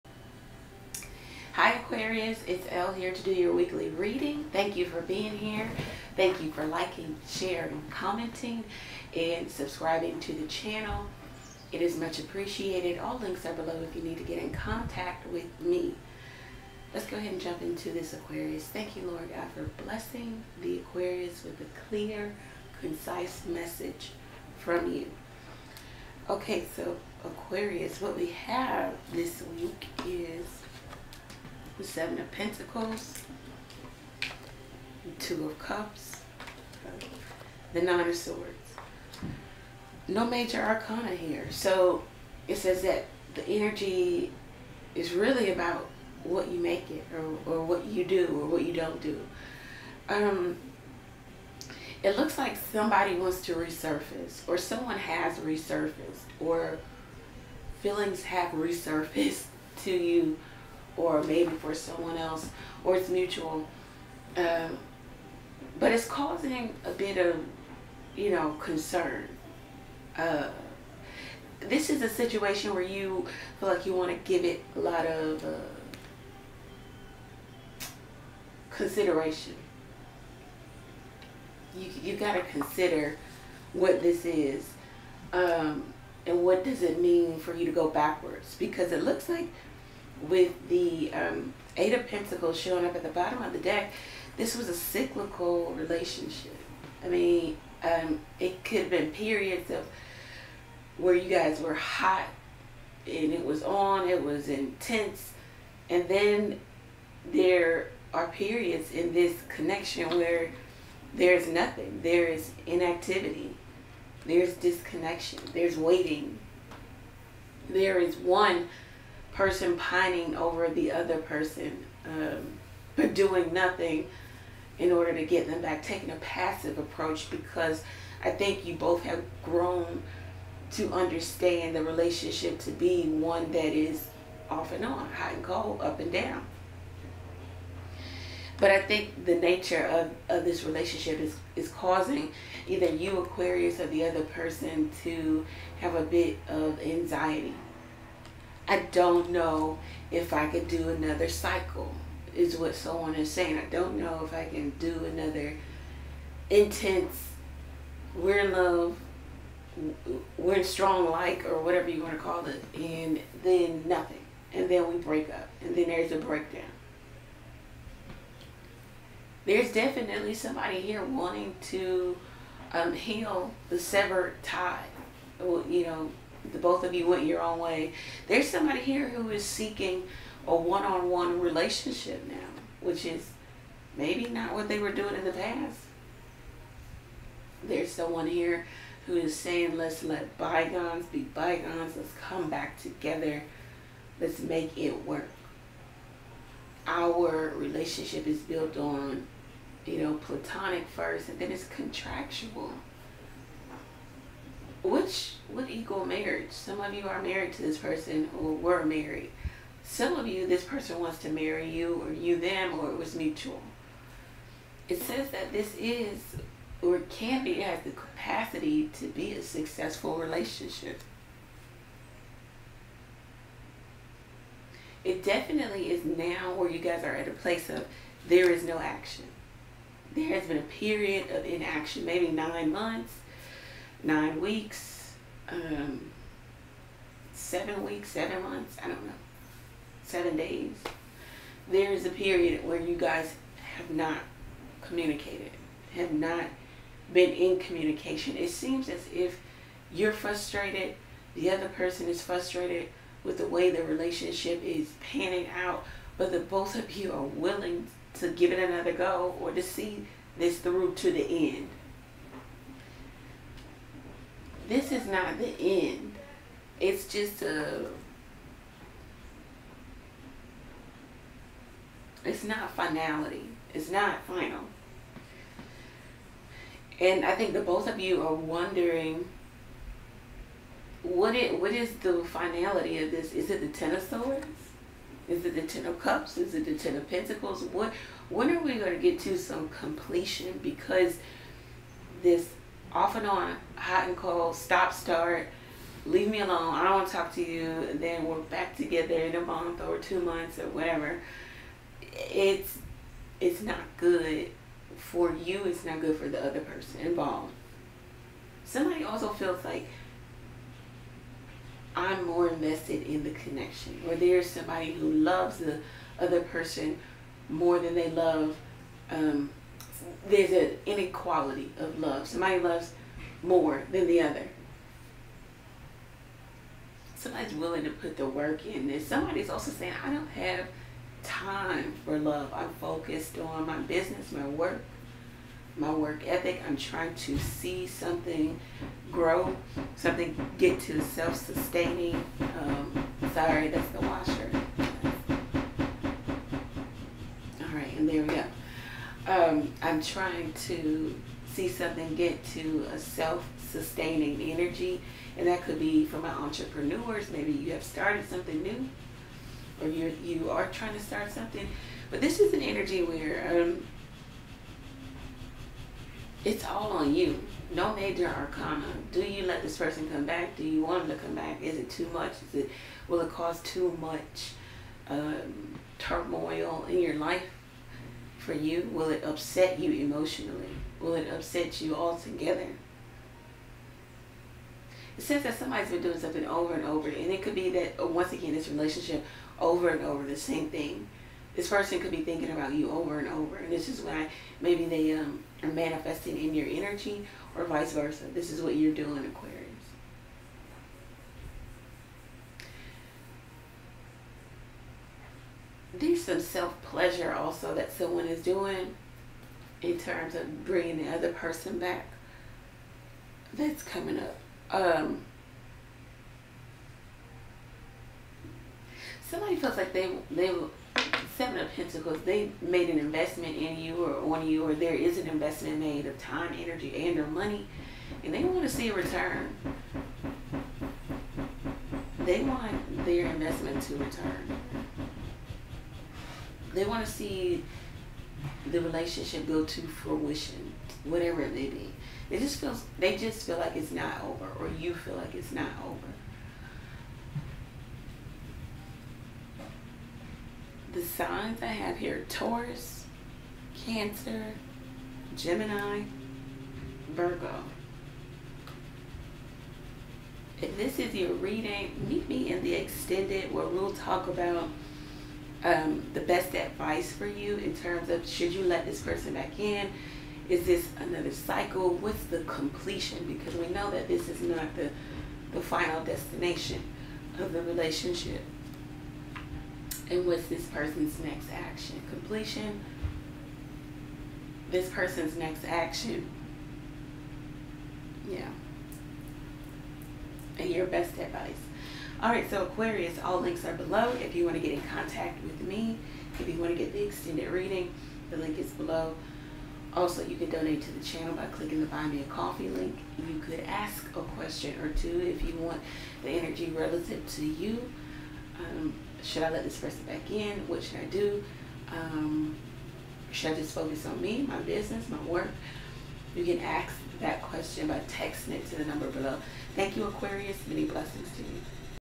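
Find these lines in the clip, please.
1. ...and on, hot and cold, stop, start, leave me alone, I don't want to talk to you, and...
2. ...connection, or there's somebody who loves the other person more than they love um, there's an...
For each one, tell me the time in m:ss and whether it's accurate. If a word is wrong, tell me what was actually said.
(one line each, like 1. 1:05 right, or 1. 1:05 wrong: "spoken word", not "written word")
1. 4:53 right
2. 5:13 right.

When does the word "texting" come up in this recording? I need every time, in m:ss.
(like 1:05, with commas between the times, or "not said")
8:38.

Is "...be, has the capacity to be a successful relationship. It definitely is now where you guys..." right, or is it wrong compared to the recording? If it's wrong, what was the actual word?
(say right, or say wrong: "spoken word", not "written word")
right.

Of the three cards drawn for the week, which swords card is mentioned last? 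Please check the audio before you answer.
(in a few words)
Nine of Swords.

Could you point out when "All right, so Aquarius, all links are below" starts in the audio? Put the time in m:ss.
8:12.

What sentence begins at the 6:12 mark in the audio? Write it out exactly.
Is it will it cause too much um, turmoil in your life?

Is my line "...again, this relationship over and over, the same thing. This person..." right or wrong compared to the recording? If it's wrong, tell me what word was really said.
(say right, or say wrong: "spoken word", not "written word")
right.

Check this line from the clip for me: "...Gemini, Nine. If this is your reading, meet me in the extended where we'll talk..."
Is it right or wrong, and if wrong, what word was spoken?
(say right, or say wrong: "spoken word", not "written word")
wrong: "Virgo", not "Nine".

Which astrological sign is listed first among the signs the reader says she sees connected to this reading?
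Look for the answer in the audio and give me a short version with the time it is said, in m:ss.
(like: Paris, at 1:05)
Taurus, at 7:32.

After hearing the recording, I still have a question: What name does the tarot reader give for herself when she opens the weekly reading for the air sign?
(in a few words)
Elle.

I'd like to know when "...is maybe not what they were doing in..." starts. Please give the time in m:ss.
3:03.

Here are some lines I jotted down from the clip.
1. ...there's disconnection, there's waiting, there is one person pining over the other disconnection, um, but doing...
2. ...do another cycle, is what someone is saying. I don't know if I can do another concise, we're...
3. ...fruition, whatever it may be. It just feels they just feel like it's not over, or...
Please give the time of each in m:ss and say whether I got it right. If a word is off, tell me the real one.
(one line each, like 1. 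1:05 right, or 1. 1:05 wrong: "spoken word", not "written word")
1. 1:54 wrong: "person", not "disconnection"
2. 2:30 wrong: "intense", not "concise"
3. 7:19 right.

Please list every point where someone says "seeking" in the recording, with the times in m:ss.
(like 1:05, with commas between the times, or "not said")
2:59.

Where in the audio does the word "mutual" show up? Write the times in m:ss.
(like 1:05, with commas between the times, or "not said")
1:03, 3:33.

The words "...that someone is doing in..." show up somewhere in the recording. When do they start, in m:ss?
6:47.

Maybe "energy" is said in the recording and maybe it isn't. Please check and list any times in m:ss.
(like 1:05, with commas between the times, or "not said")
0:43, 5:54, 6:02, 6:36, 7:06, 8:26.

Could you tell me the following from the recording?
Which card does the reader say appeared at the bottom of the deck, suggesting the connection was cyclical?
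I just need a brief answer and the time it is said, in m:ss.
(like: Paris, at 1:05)
Eight of Pentacles, at 1:31.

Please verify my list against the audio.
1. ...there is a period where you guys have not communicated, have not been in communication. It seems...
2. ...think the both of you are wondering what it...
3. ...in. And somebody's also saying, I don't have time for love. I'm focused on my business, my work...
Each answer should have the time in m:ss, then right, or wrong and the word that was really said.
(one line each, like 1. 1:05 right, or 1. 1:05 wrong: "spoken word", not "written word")
1. 4:01 right
2. 4:37 right
3. 5:28 right.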